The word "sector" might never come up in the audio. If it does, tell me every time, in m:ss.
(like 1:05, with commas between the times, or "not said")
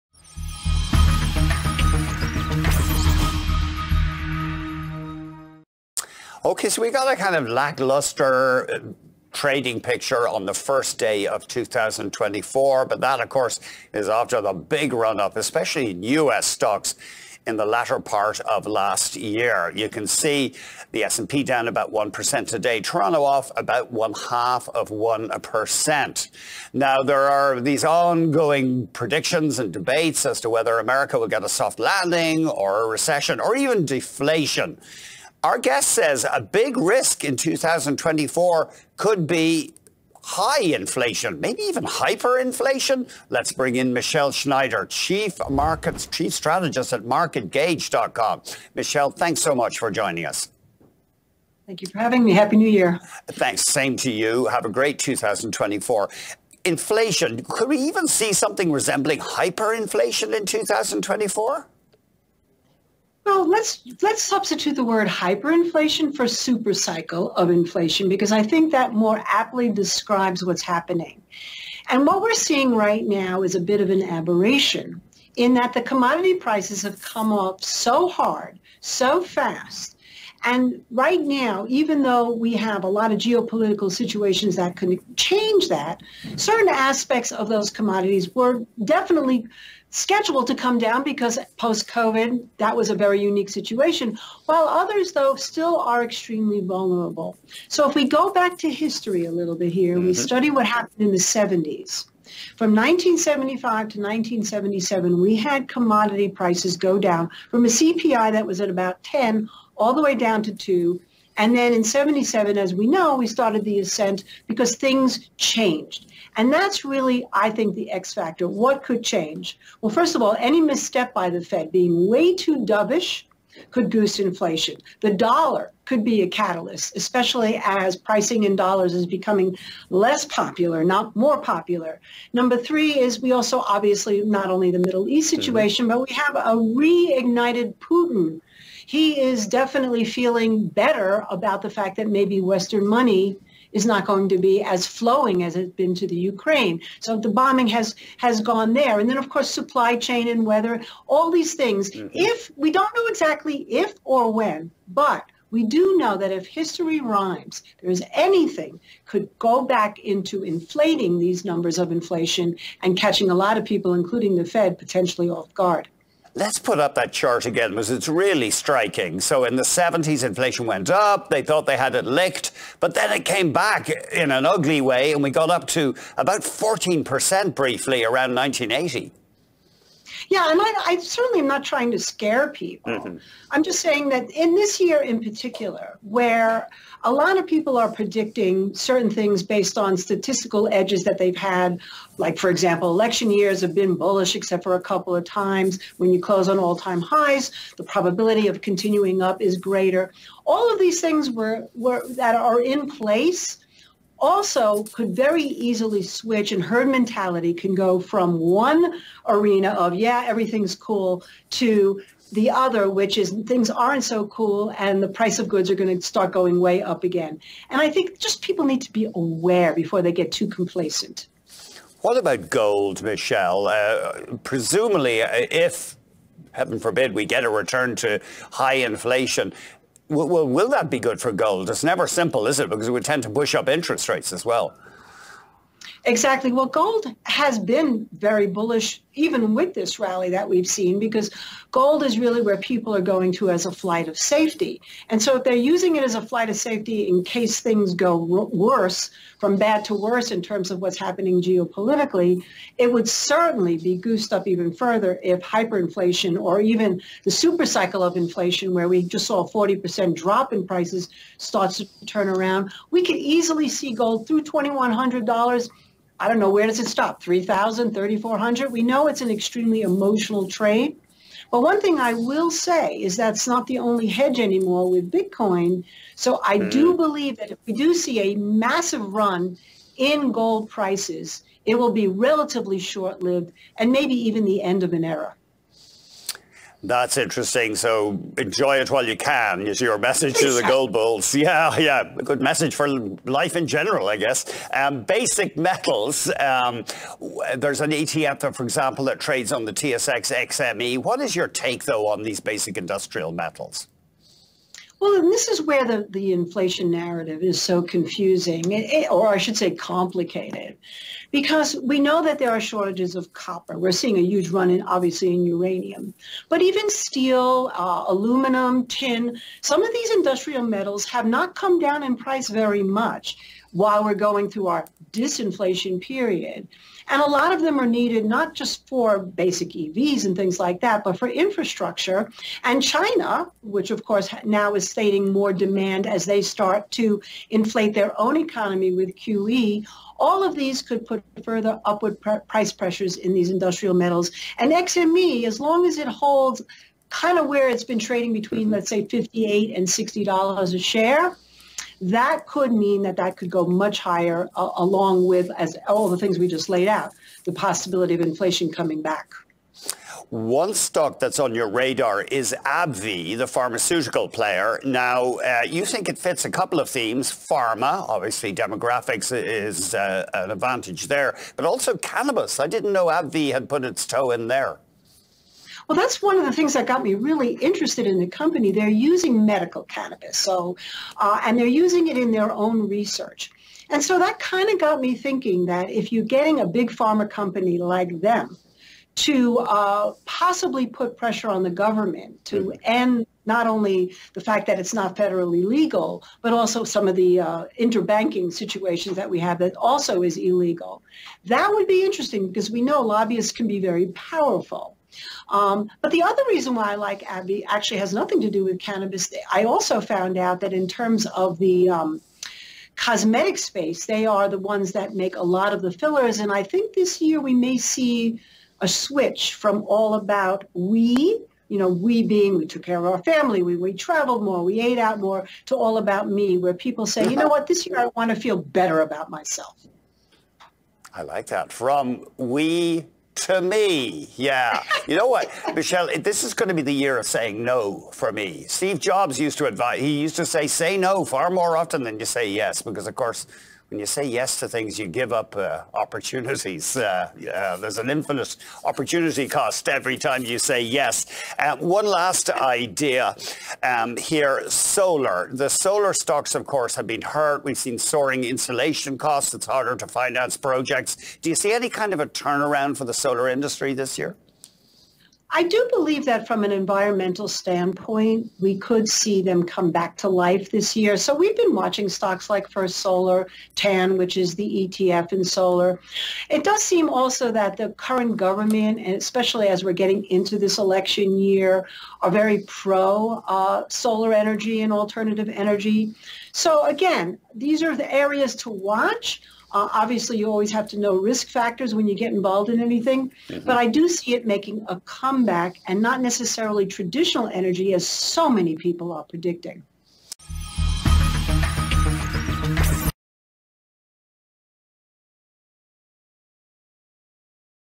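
not said.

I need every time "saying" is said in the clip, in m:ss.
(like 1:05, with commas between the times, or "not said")
3:03, 7:17.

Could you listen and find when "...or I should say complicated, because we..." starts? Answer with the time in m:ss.
5:09.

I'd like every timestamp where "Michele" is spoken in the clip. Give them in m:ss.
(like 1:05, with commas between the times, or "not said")
0:43, 0:48, 3:43, 7:15.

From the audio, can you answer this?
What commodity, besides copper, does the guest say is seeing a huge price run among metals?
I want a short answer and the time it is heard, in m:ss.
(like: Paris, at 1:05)
uranium, at 5:15.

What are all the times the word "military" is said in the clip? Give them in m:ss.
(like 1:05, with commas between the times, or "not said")
not said.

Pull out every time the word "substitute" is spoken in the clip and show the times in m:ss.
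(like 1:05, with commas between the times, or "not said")
1:04.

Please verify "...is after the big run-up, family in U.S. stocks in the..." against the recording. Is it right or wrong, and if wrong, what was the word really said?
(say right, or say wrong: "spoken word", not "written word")
wrong: "especially", not "family".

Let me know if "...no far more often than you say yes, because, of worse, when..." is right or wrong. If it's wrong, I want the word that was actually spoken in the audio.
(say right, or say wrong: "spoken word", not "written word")
wrong: "course", not "worse".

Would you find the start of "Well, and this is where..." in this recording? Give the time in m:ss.
5:05.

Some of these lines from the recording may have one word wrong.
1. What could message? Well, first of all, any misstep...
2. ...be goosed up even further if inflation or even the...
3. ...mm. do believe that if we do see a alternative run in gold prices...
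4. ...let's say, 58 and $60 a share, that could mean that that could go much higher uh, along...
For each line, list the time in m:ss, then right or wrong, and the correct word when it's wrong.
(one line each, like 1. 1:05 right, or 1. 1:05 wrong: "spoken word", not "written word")
1. 1:58 wrong: "change", not "message"
2. 4:13 wrong: "hyperinflation", not "inflation"
3. 4:36 wrong: "massive", not "alternative"
4. 5:48 right.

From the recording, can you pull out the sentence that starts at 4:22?
We could easily see gold through $2,100 I don't know, where does it stop?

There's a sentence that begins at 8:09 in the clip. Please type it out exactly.
Uh, obviously, you always have to know risk factors when you get involved in anything, mm -hmm.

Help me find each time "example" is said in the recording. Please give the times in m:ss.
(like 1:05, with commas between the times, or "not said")
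3:12, 4:58.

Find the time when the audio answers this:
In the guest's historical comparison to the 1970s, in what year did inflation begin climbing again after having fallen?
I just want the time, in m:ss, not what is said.
1:51.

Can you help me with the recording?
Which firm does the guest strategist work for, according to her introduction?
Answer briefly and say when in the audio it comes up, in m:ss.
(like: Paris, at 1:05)
MarketGauge.com, at 0:47.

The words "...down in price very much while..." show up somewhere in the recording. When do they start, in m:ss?
5:21.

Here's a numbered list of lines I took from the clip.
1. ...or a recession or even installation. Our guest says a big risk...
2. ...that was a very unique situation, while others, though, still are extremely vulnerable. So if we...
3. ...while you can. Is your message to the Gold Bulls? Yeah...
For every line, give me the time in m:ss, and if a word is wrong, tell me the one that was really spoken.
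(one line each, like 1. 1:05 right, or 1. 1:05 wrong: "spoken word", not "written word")
1. 0:32 wrong: "deflation", not "installation"
2. 1:32 right
3. 4:48 right.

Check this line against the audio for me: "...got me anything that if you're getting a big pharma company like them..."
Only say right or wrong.
wrong.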